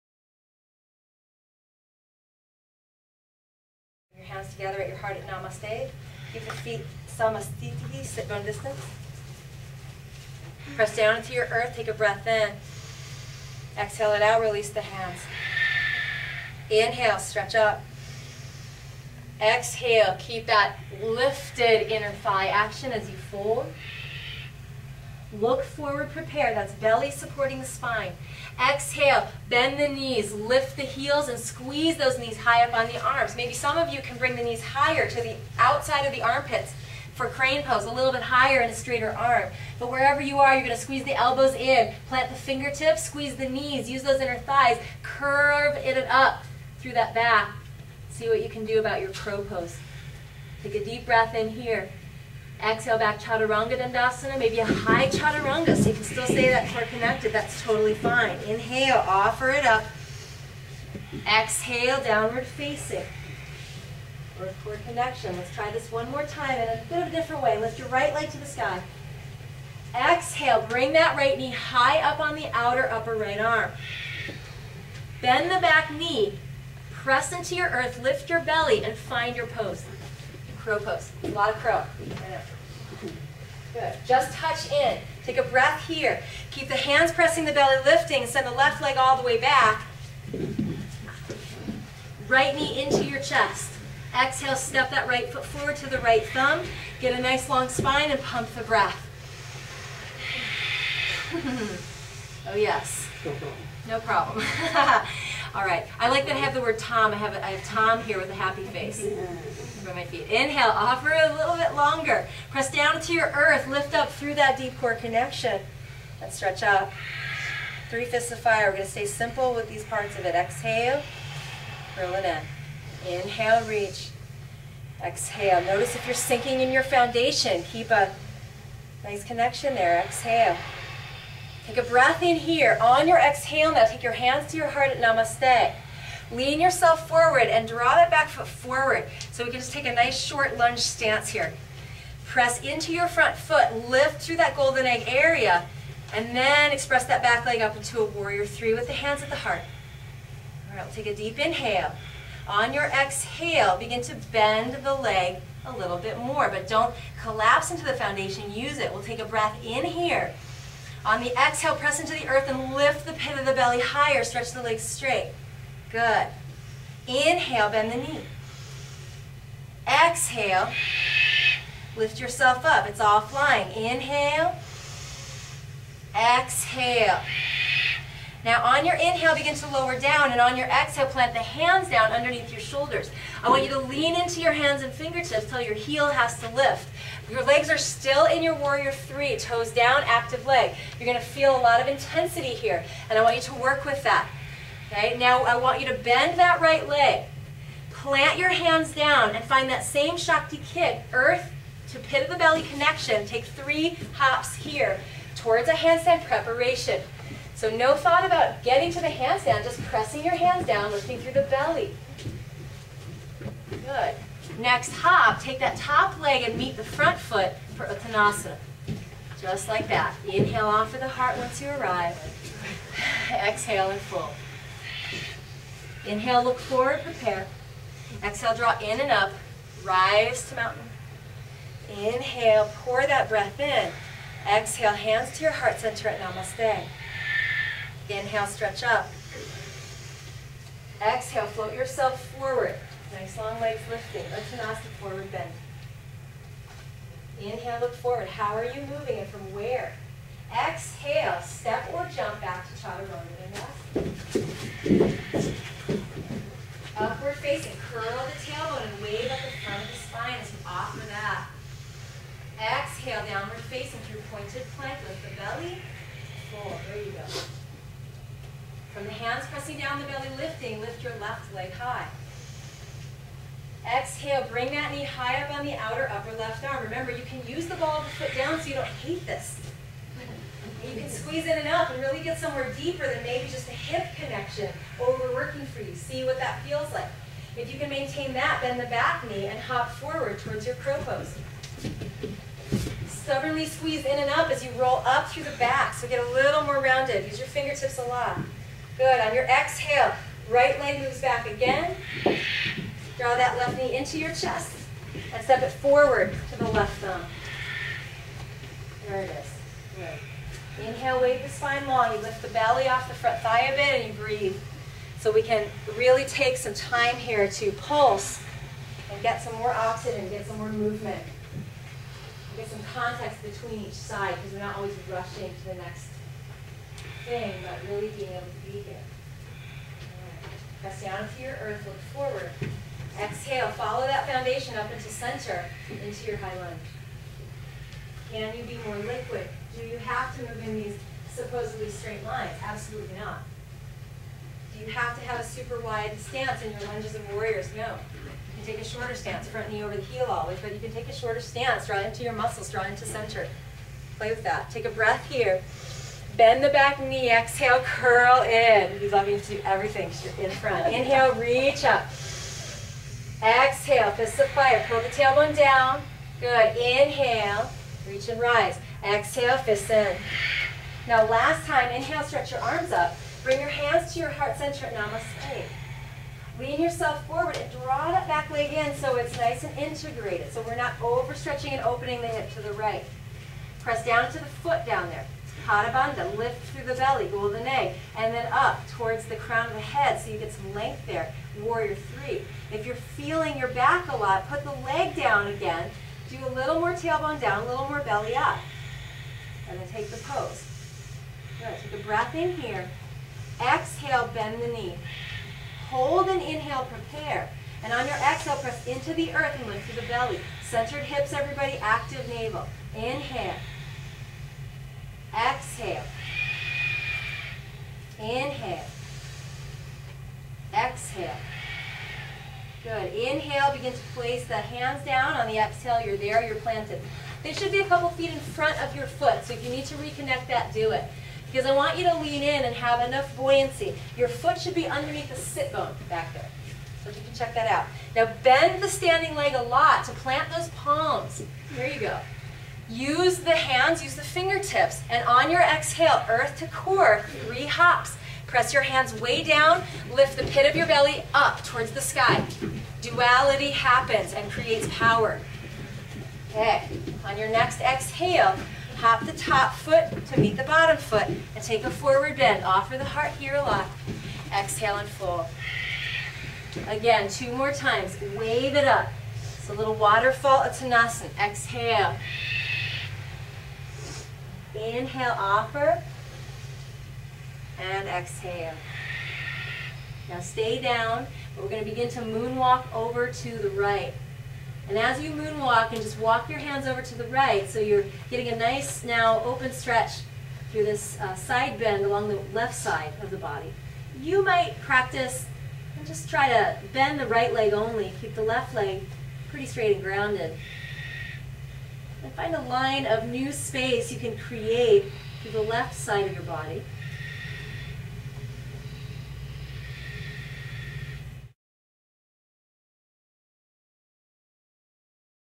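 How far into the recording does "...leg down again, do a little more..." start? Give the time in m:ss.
6:34.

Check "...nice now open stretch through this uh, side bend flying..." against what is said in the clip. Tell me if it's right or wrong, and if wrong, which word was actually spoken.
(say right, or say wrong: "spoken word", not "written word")
wrong: "along", not "flying".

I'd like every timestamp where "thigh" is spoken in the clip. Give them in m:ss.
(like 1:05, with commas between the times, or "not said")
0:22, 0:44, 5:13.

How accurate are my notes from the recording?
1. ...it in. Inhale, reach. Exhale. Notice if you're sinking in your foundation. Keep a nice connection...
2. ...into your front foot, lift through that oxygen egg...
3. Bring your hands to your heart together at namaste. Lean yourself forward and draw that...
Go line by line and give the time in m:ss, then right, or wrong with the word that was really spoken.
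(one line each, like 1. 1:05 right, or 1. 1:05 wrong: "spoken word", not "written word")
1. 2:02 right
2. 2:22 wrong: "golden", not "oxygen"
3. 6:13 wrong: "center", not "together".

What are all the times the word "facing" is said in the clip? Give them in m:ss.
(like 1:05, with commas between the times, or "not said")
1:02, 4:17, 4:23.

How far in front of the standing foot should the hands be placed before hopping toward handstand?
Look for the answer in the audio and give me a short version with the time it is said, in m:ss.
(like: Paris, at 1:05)
a couple feet, at 7:07.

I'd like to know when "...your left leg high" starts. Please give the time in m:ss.
4:31.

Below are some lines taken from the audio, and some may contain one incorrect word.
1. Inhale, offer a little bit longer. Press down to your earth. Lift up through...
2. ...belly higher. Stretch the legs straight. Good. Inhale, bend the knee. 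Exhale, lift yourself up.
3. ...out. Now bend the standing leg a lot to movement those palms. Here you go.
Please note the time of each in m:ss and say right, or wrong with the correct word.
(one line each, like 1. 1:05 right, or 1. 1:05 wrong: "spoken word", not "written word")
1. 1:50 right
2. 2:43 right
3. 7:17 wrong: "plant", not "movement".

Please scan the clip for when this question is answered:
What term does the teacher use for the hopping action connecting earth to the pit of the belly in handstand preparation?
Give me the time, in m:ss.
3:20.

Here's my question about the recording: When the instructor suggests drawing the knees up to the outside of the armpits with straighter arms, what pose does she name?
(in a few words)
crane pose.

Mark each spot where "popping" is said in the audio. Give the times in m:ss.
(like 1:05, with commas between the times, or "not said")
not said.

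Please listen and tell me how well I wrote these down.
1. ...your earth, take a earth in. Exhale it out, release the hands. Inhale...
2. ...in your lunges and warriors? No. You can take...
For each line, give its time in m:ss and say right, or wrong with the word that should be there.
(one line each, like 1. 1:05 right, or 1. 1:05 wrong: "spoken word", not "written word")
1. 0:11 wrong: "breath", not "earth"
2. 5:46 right.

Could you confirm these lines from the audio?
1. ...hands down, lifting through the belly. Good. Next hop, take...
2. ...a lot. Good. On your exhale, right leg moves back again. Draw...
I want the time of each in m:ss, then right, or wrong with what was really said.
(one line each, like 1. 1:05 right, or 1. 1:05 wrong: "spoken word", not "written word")
1. 3:30 right
2. 4:57 right.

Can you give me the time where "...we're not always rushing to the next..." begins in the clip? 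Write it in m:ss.
5:24.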